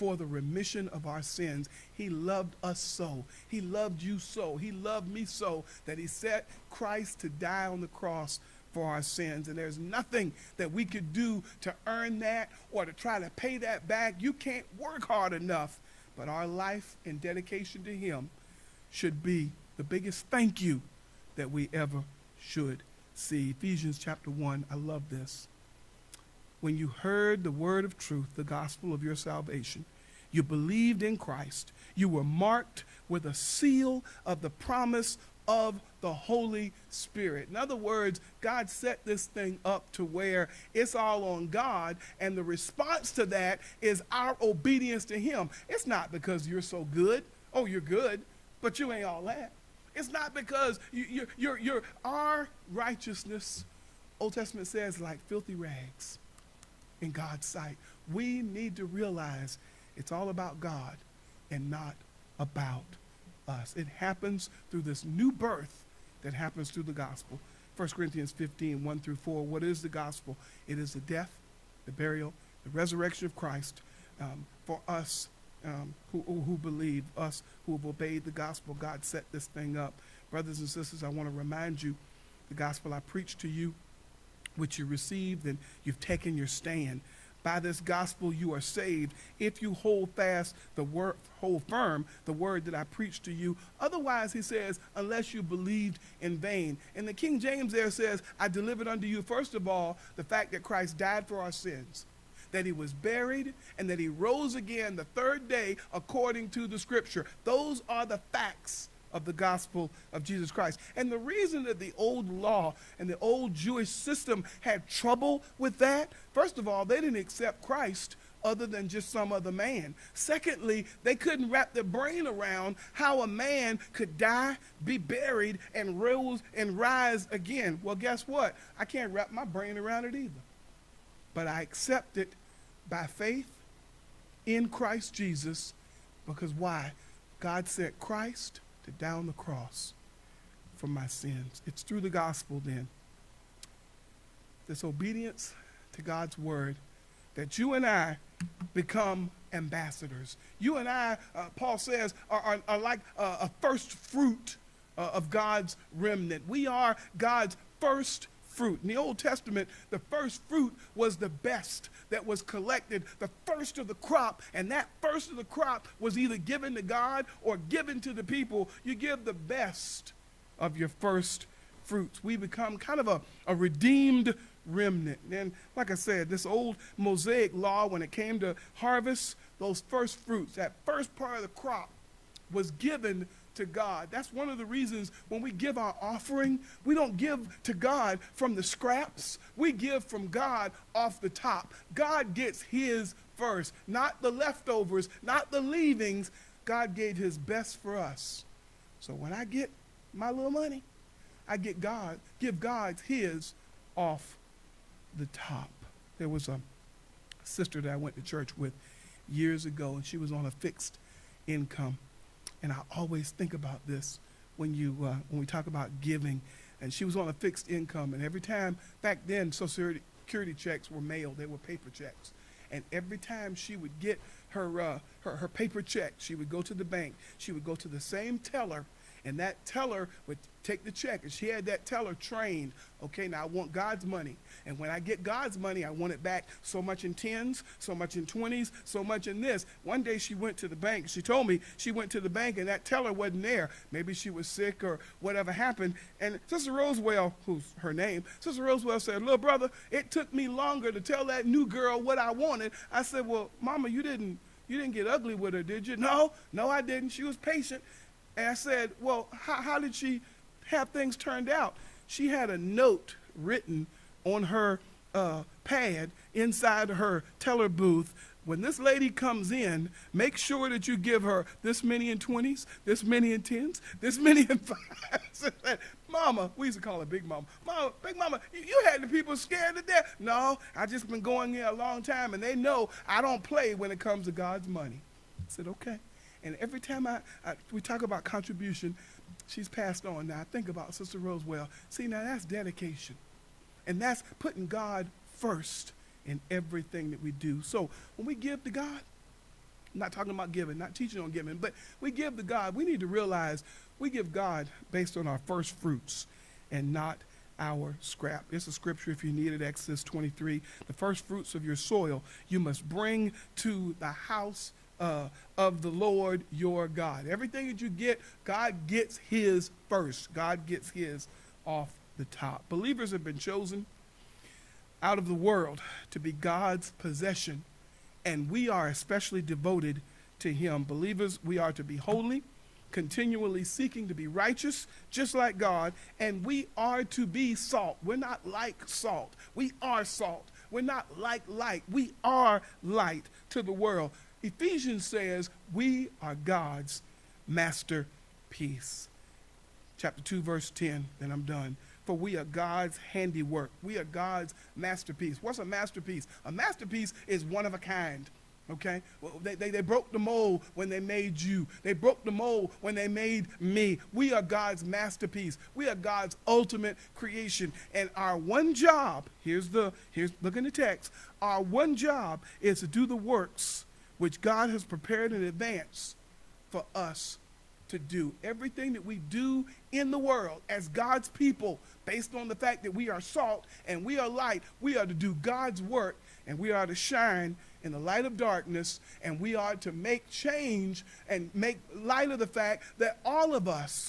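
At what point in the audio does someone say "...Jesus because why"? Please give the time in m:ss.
2:15.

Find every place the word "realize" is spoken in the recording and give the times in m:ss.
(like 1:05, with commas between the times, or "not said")
0:58, 5:03.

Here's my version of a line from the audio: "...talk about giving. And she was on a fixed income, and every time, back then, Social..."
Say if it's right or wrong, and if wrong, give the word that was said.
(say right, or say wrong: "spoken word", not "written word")
right.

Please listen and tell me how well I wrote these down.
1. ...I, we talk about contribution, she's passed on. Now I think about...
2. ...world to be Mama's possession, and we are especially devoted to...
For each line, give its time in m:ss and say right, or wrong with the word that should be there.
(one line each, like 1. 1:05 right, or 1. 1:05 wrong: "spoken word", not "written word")
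1. 4:47 right
2. 5:25 wrong: "God", not "Mama".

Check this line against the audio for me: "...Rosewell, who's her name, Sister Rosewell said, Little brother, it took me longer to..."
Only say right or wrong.
right.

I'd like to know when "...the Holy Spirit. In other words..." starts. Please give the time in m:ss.
0:36.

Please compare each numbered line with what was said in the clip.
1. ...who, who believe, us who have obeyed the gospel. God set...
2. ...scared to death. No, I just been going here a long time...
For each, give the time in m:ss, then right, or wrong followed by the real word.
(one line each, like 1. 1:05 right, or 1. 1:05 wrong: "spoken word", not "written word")
1. 1:16 right
2. 4:39 right.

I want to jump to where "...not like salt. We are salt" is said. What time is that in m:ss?
5:38.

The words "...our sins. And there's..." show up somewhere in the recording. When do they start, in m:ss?
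0:08.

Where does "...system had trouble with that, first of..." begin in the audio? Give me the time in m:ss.
1:53.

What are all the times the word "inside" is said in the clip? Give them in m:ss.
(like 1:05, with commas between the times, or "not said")
4:26.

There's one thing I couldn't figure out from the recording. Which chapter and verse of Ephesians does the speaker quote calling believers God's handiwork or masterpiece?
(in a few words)
Chapter 2, verse 10.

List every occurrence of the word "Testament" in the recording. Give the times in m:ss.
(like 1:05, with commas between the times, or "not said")
0:54, 2:39.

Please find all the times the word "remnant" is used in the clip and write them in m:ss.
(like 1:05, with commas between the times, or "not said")
2:35, 2:54.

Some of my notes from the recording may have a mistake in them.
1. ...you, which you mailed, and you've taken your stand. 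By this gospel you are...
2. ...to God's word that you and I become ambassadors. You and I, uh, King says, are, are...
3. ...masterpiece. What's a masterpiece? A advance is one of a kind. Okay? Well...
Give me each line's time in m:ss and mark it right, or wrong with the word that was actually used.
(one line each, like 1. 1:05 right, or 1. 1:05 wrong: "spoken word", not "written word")
1. 1:23 wrong: "received", not "mailed"
2. 2:25 wrong: "Paul", not "King"
3. 5:54 wrong: "masterpiece", not "advance".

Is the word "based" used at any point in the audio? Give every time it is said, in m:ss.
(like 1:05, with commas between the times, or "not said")
5:04, 6:22.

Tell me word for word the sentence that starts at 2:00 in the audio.
Secondly, they couldn't wrap their brain around how a man could die, be buried, and rose and rise again.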